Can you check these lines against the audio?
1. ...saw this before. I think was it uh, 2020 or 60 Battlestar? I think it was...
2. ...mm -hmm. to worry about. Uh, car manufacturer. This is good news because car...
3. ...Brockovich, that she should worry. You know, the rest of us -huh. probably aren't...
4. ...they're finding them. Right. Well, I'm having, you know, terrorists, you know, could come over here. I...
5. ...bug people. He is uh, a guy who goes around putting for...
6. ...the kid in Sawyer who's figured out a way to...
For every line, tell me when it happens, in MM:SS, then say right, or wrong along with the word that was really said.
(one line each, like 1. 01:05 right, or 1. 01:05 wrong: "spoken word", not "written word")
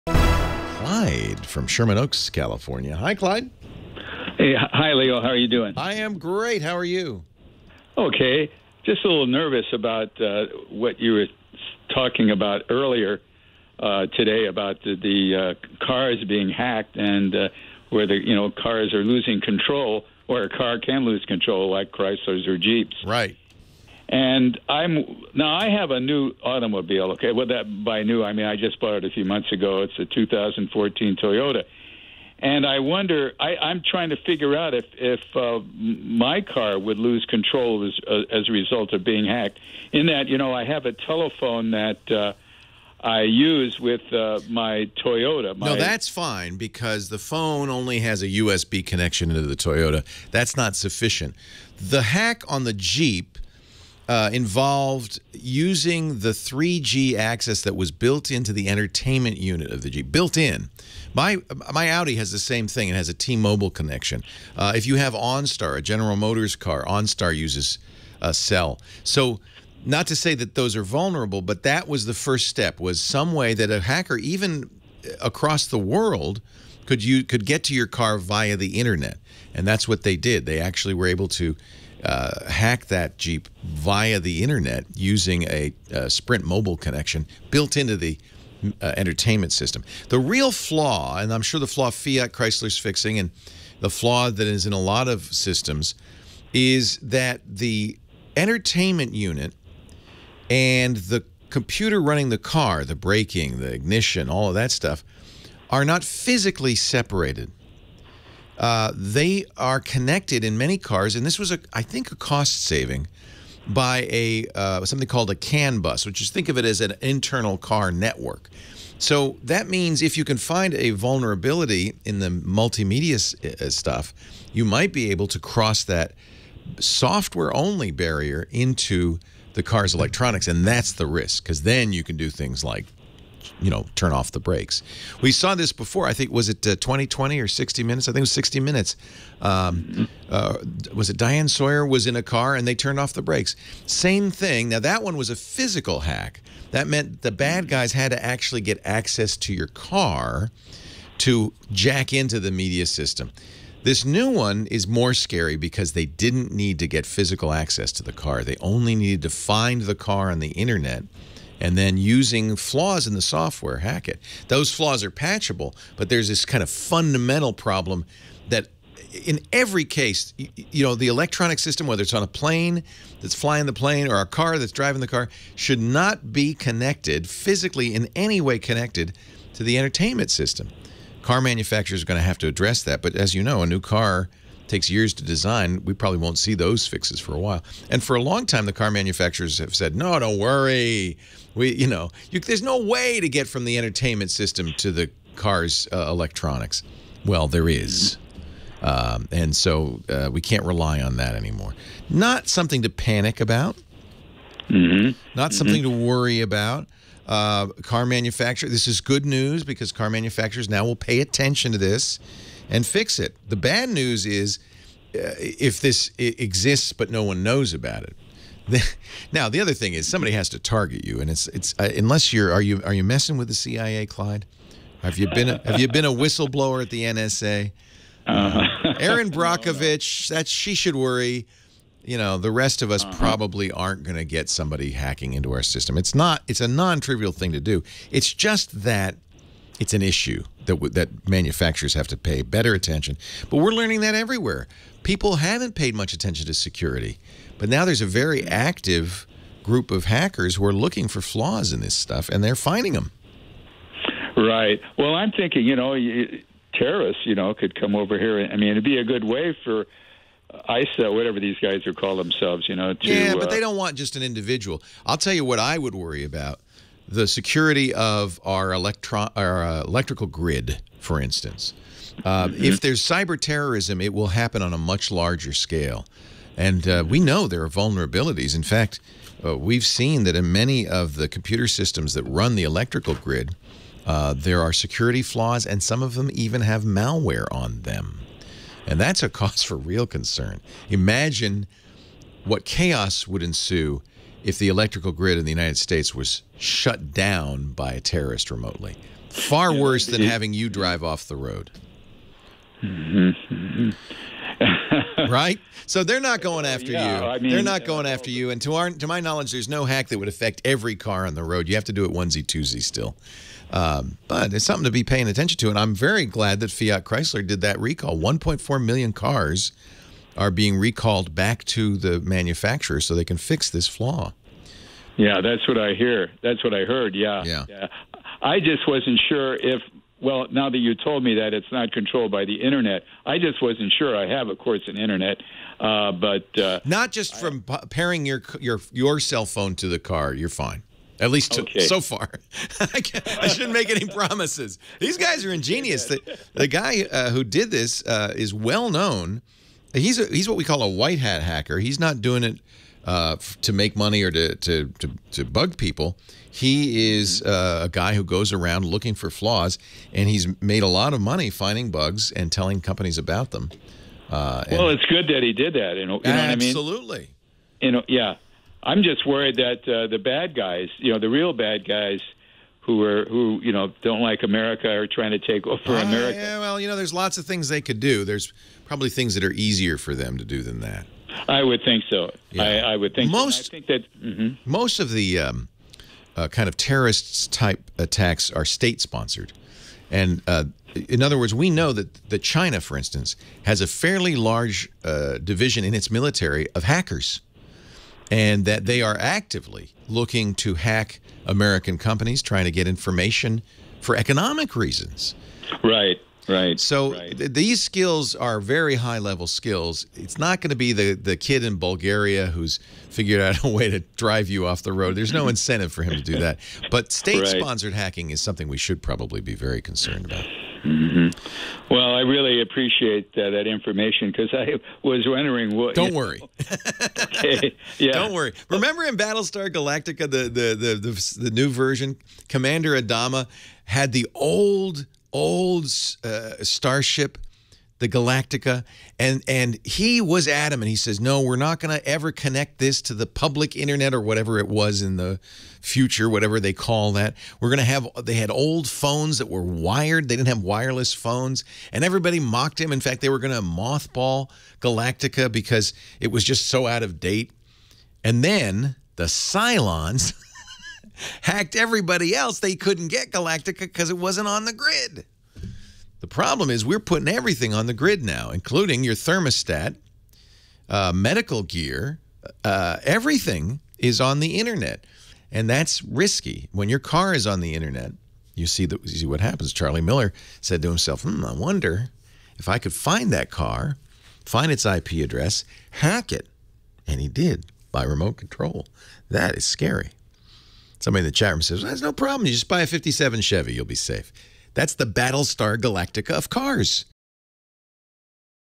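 1. 02:15 wrong: "Minutes", not "Battlestar"
2. 03:25 right
3. 03:49 right
4. 04:12 wrong: "thinking", not "having"
5. 05:55 wrong: "looking", not "putting"
6. 06:51 wrong: "Bulgaria", not "Sawyer".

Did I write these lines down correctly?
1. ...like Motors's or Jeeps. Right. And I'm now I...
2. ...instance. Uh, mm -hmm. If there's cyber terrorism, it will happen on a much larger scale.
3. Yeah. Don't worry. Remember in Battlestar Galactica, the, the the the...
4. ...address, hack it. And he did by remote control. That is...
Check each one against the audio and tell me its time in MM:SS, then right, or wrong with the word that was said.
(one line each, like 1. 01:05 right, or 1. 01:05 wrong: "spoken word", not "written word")
1. 00:21 wrong: "Chrysler", not "Motors"
2. 04:31 right
3. 07:07 right
4. 08:05 right.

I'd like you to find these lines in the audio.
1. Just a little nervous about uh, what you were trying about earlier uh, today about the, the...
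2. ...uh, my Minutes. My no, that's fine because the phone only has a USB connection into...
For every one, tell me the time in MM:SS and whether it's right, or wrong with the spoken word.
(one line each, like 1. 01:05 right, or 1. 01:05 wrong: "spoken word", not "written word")
1. 00:08 wrong: "talking", not "trying"
2. 00:44 wrong: "Toyota", not "Minutes".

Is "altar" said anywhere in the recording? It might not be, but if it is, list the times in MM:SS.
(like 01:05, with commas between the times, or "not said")
not said.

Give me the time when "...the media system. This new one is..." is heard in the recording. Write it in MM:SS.
02:32.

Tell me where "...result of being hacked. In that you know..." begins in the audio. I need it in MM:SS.
00:38.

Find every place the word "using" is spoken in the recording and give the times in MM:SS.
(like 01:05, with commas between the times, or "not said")
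00:55, 01:24, 02:41.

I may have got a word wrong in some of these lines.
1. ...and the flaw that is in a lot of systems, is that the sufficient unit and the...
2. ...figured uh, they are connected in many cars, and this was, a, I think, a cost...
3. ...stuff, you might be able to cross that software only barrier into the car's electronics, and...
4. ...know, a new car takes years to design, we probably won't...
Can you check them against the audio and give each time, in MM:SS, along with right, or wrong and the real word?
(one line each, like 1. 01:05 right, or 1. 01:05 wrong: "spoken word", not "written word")
1. 01:33 wrong: "entertainment", not "sufficient"
2. 01:46 wrong: "separated", not "figured"
3. 02:03 right
4. 03:03 right.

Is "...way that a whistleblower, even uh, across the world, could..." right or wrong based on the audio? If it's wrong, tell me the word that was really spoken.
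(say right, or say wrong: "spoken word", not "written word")
wrong: "hacker", not "whistleblower".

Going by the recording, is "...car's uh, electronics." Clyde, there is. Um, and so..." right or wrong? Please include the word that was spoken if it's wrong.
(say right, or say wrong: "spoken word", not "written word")
wrong: "Well", not "Clyde".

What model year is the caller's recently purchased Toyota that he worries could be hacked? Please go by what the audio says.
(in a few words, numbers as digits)
2014.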